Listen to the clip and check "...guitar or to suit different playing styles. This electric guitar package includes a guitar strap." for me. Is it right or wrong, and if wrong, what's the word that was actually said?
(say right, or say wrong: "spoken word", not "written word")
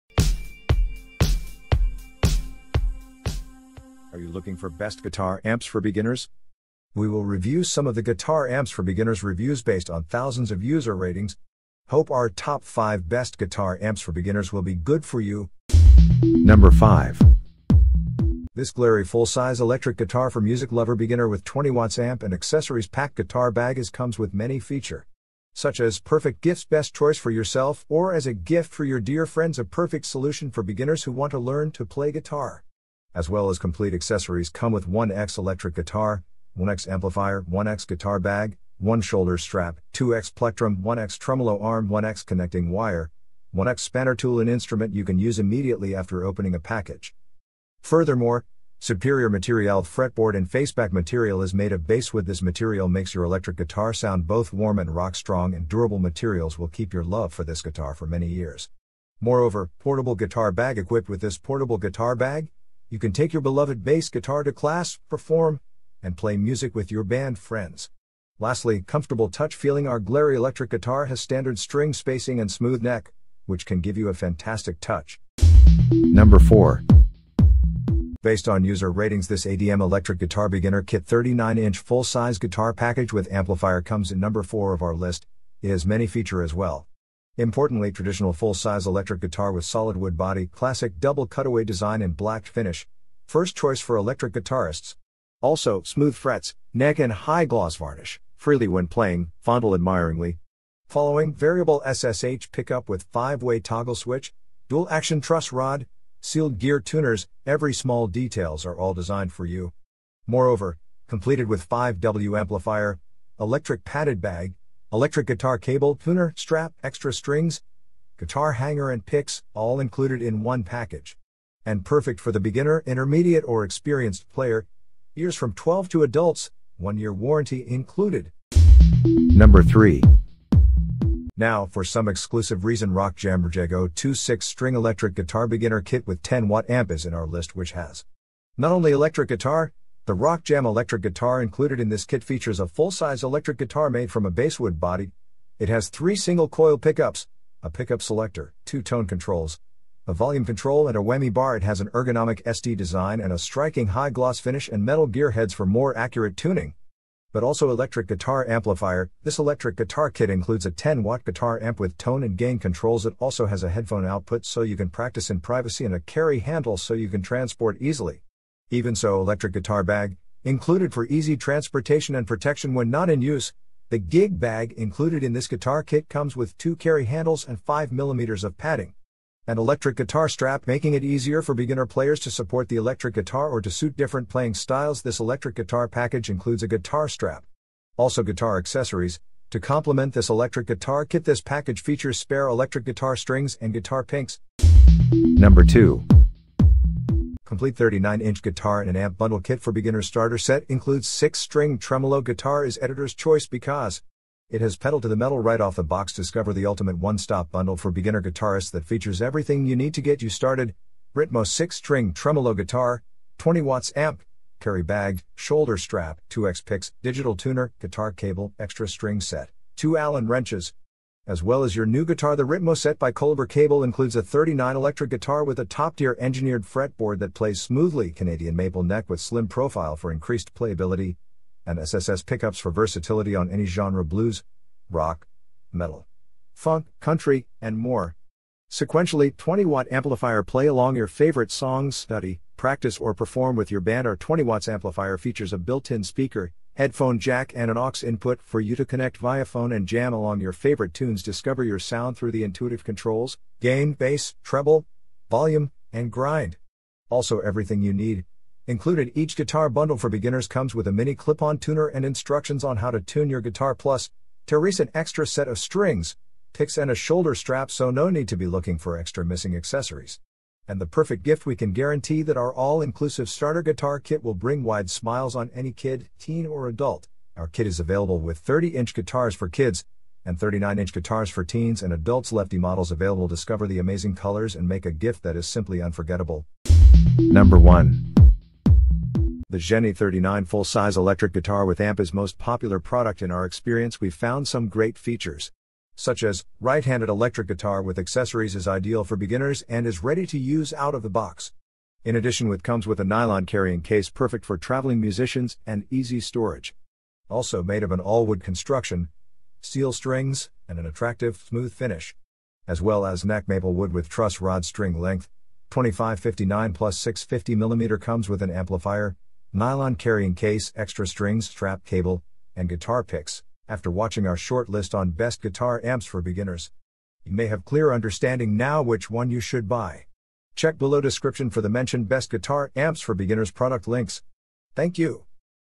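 right.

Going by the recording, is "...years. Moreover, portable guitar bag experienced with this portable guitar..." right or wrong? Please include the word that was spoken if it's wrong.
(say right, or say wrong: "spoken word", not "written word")
wrong: "equipped", not "experienced".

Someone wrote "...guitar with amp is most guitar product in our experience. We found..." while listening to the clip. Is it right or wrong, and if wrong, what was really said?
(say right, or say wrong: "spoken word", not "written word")
wrong: "popular", not "guitar".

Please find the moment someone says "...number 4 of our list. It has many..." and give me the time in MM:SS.
01:24.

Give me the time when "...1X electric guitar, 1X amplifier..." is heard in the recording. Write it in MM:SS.
00:34.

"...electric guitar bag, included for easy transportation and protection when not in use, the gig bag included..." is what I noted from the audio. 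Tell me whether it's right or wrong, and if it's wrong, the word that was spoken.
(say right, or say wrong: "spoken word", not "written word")
right.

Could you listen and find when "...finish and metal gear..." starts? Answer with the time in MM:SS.
02:34.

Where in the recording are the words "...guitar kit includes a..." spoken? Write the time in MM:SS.
02:39.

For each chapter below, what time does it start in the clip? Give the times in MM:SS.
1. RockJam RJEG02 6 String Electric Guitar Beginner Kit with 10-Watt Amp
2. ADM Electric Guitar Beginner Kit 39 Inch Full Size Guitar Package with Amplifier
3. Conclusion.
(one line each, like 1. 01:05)
1. 02:06
2. 01:14
3. 05:18.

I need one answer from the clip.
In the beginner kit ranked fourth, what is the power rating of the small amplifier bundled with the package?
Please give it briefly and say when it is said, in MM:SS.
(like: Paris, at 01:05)
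5W, at 01:51.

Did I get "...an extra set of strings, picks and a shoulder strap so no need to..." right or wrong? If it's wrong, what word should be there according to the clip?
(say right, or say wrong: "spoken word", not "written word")
right.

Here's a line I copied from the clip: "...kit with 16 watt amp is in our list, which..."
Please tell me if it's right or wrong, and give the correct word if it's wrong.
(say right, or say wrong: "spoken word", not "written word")
wrong: "10", not "16".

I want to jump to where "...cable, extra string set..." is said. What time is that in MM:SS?
03:38.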